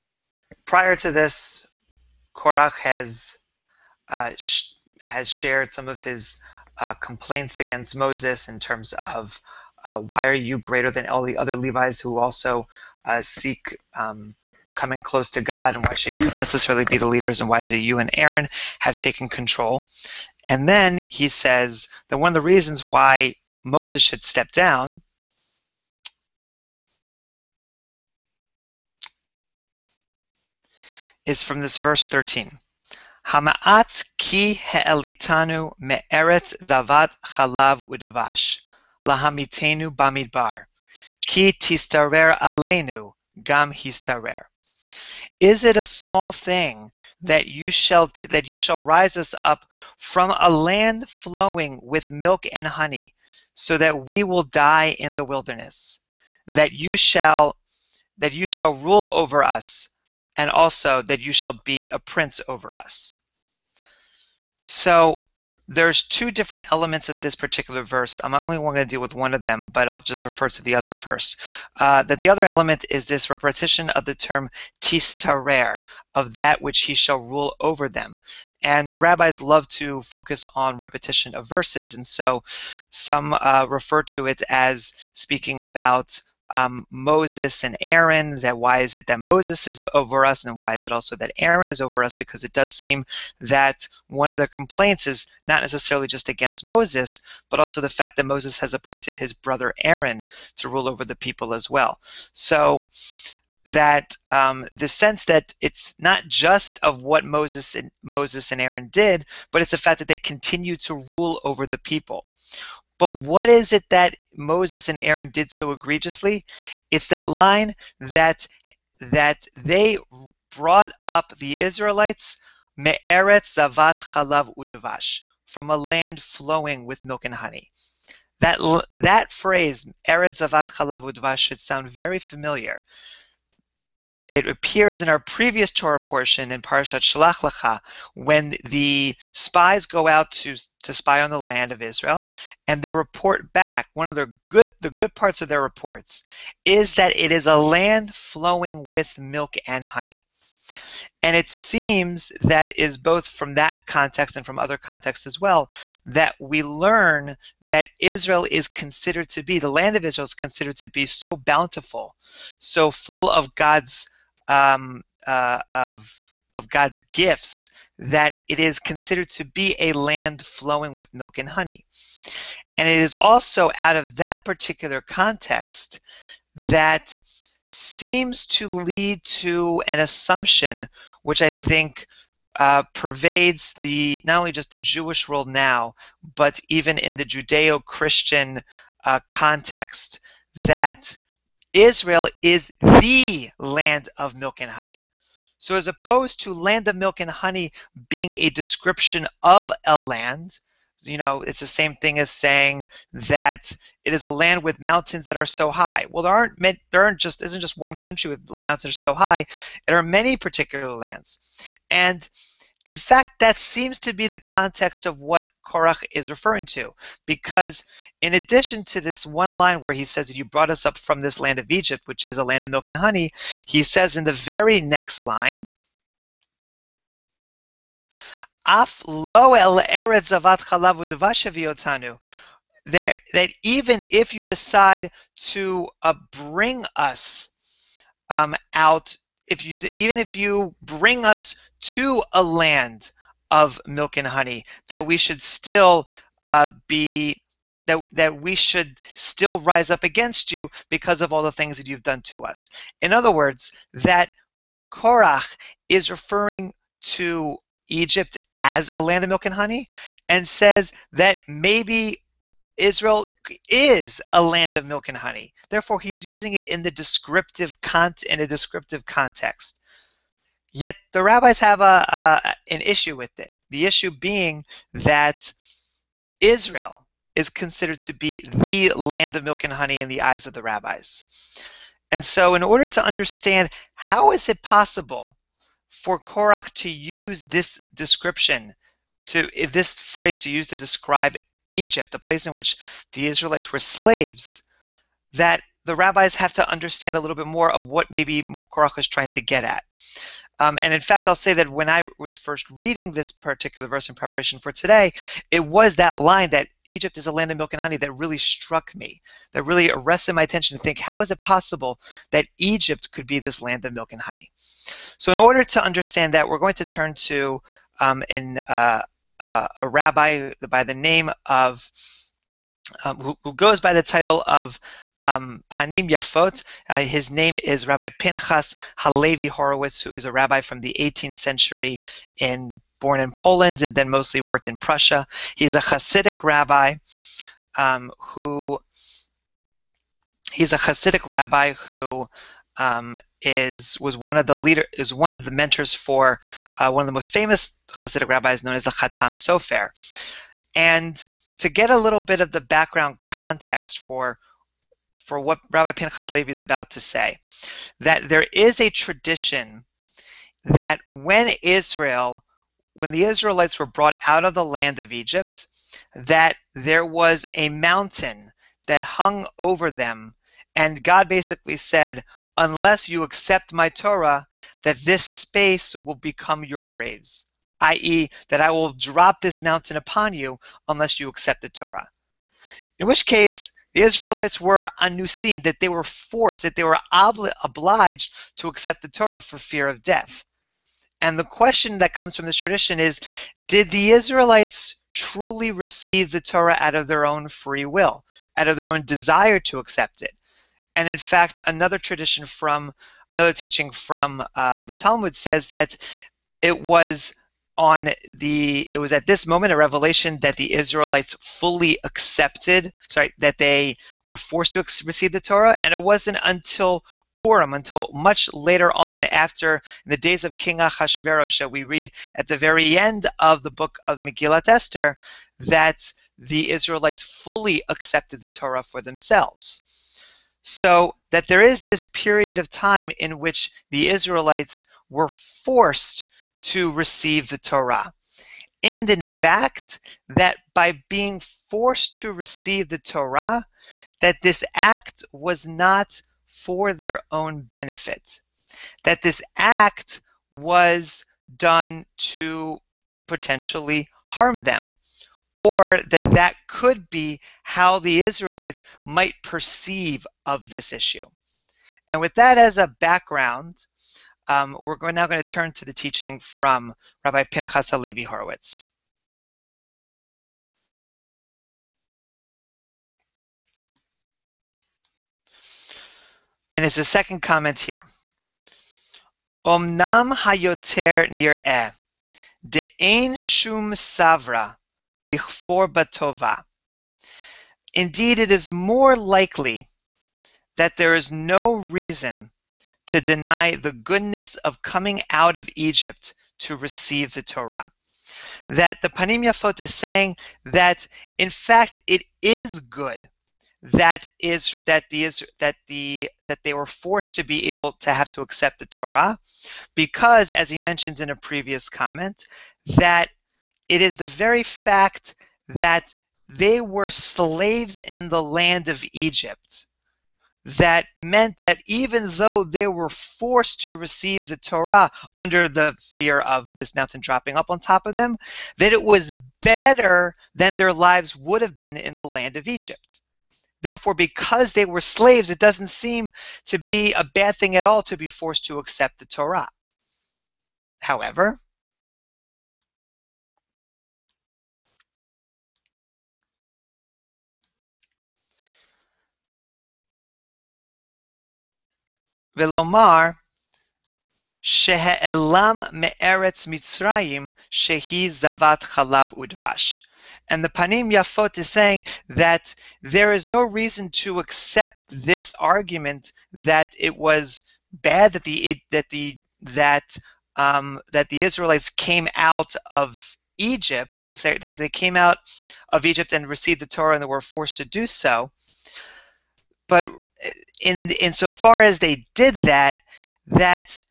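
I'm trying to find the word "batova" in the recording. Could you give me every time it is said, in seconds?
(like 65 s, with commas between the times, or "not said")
485 s.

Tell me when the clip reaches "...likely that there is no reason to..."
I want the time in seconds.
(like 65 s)
489 s.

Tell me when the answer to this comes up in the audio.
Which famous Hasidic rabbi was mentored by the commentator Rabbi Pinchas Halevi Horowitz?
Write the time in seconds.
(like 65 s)
348 s.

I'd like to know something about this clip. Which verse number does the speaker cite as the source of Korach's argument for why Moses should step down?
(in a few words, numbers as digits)
13.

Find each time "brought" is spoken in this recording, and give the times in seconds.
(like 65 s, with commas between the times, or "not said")
120 s, 220 s, 363 s.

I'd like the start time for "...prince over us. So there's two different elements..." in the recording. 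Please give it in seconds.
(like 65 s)
61 s.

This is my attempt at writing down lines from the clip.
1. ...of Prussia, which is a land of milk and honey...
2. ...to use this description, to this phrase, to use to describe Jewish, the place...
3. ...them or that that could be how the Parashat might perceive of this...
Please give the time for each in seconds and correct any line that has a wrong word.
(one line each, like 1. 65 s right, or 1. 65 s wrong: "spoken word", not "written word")
1. 221 s wrong: "Egypt", not "Prussia"
2. 286 s wrong: "Egypt", not "Jewish"
3. 454 s wrong: "Israelites", not "Parashat".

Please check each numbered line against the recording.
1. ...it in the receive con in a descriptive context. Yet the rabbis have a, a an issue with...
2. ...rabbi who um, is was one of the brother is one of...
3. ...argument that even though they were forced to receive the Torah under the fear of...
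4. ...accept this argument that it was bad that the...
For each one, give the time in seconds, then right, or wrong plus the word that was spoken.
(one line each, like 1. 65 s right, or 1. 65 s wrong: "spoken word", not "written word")
1. 266 s wrong: "descriptive", not "receive"
2. 341 s wrong: "leader", not "brother"
3. 521 s wrong: "meant", not "argument"
4. 564 s right.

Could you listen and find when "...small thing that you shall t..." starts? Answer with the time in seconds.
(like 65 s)
45 s.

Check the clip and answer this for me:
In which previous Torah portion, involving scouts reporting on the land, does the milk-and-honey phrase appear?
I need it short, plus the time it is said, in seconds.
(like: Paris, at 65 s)
Shalach Lecha, at 136 s.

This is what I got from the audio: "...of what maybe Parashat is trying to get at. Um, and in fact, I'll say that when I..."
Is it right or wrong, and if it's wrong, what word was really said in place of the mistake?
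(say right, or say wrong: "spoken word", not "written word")
wrong: "Korach", not "Parashat".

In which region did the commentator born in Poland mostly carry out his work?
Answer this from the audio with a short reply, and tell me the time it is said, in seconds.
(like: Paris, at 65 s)
Prussia, at 334 s.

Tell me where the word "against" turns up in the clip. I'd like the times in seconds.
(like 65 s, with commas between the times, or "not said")
7 s, 96 s, 250 s.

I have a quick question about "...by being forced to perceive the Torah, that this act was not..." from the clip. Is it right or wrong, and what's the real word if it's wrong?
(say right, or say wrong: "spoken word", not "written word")
wrong: "receive", not "perceive".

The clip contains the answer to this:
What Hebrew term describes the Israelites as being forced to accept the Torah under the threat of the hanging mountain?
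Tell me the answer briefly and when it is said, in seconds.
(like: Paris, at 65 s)
anusim, at 385 s.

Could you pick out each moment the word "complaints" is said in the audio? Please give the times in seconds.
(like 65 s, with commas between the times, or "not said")
6 s, 94 s.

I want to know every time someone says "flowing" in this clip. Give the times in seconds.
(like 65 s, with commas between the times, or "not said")
51 s, 126 s, 148 s, 170 s.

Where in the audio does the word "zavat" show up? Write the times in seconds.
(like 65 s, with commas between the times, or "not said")
36 s, 123 s, 130 s, 558 s.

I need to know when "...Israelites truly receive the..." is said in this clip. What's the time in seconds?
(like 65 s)
394 s.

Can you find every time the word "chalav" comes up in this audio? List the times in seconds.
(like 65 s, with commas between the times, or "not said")
37 s, 124 s, 130 s, 230 s, 558 s.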